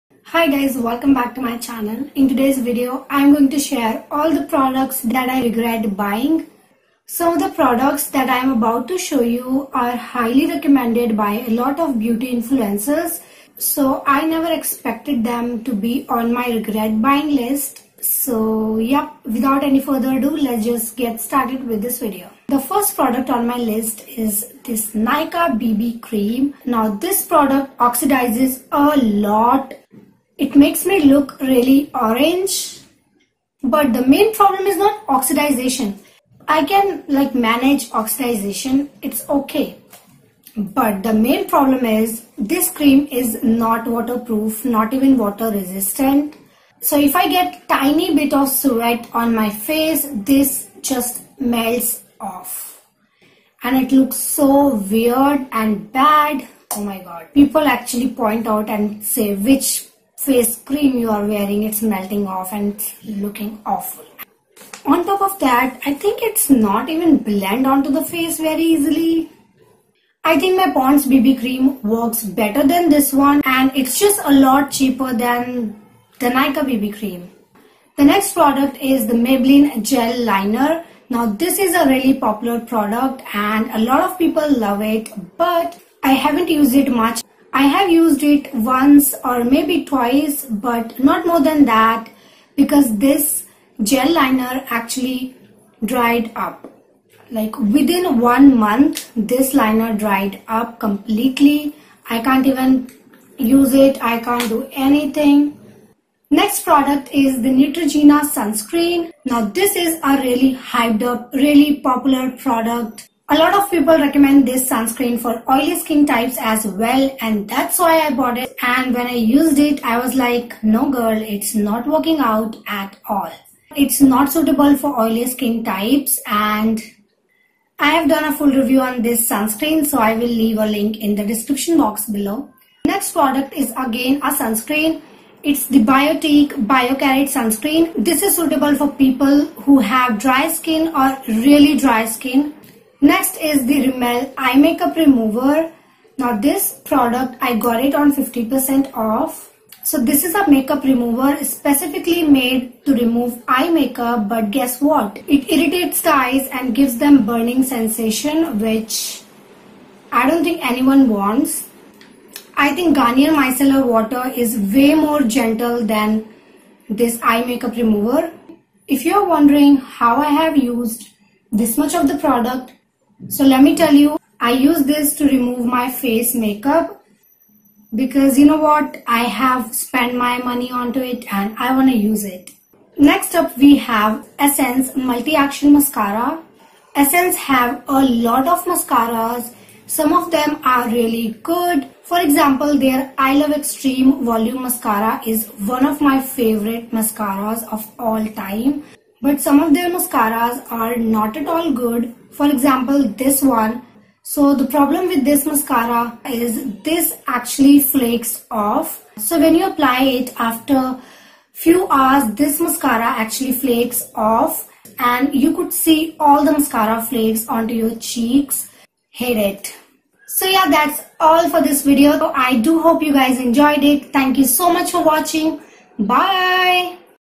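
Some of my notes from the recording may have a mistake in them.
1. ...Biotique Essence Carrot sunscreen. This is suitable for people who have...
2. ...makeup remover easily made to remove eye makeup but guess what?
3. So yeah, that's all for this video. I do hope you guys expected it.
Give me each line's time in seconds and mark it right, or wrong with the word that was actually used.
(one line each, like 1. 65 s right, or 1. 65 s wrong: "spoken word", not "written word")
1. 135 s wrong: "Bio", not "Essence"
2. 150 s wrong: "specifically", not "easily"
3. 220 s wrong: "enjoyed", not "expected".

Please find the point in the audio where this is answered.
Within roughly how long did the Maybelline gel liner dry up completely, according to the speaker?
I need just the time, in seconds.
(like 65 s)
98 s.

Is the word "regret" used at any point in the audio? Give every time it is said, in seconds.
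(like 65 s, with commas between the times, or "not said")
5 s, 16 s.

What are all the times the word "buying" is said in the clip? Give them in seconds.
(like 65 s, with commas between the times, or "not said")
5 s, 17 s.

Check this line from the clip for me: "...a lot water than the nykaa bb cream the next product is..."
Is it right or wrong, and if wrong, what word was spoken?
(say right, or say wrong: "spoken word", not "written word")
wrong: "cheaper", not "water".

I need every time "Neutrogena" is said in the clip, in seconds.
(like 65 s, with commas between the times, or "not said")
107 s.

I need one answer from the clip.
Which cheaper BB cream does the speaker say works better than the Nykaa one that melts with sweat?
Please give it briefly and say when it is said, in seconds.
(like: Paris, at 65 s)
Pond's BB cream, at 70 s.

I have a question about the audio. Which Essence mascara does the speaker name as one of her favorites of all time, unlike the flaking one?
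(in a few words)
I Love Extreme Volume.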